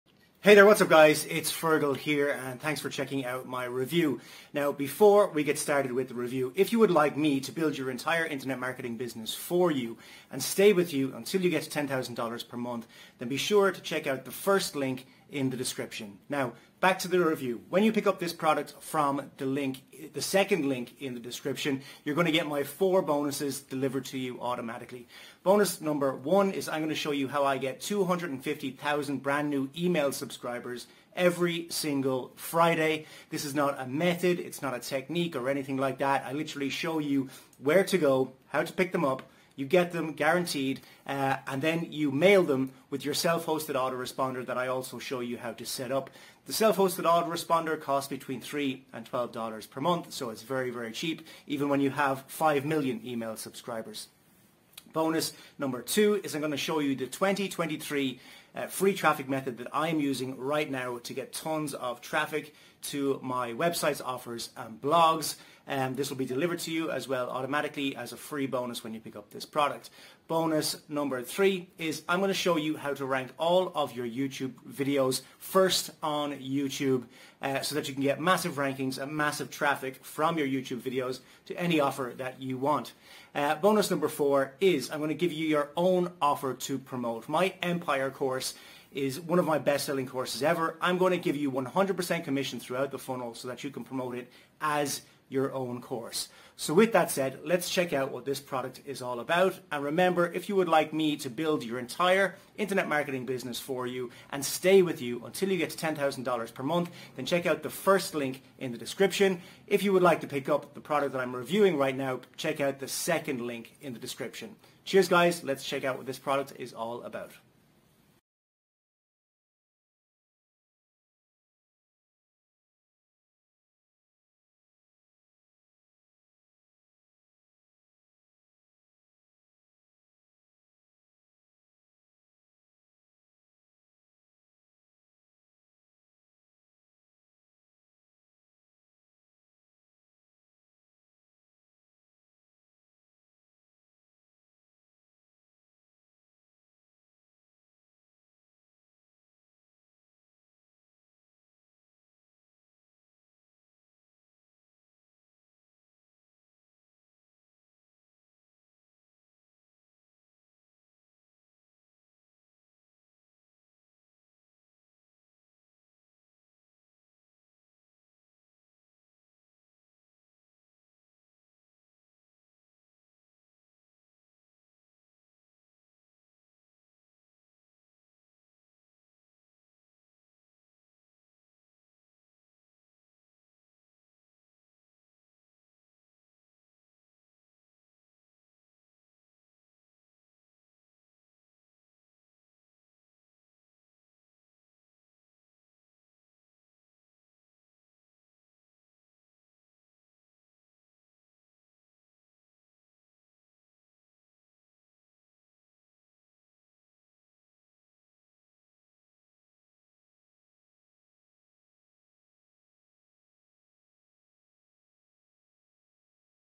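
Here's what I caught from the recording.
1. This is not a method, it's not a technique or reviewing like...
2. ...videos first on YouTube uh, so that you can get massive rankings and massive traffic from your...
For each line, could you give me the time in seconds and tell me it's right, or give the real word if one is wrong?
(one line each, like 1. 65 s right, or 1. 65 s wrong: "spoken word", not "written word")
1. 33 s wrong: "anything", not "reviewing"
2. 74 s right.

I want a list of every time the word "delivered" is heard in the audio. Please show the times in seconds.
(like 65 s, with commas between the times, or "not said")
23 s, 66 s.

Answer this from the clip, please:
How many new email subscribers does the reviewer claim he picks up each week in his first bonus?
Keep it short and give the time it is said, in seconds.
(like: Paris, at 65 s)
250,000, at 27 s.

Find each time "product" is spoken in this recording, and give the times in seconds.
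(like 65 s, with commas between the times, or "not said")
18 s, 69 s, 98 s, 110 s, 116 s.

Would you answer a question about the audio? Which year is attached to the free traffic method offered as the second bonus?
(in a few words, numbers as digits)
2023.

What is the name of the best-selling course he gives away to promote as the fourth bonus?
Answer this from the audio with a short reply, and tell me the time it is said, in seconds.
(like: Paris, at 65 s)
Empire, at 87 s.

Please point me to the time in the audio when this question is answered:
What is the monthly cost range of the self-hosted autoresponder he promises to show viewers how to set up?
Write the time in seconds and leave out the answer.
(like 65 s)
48 s.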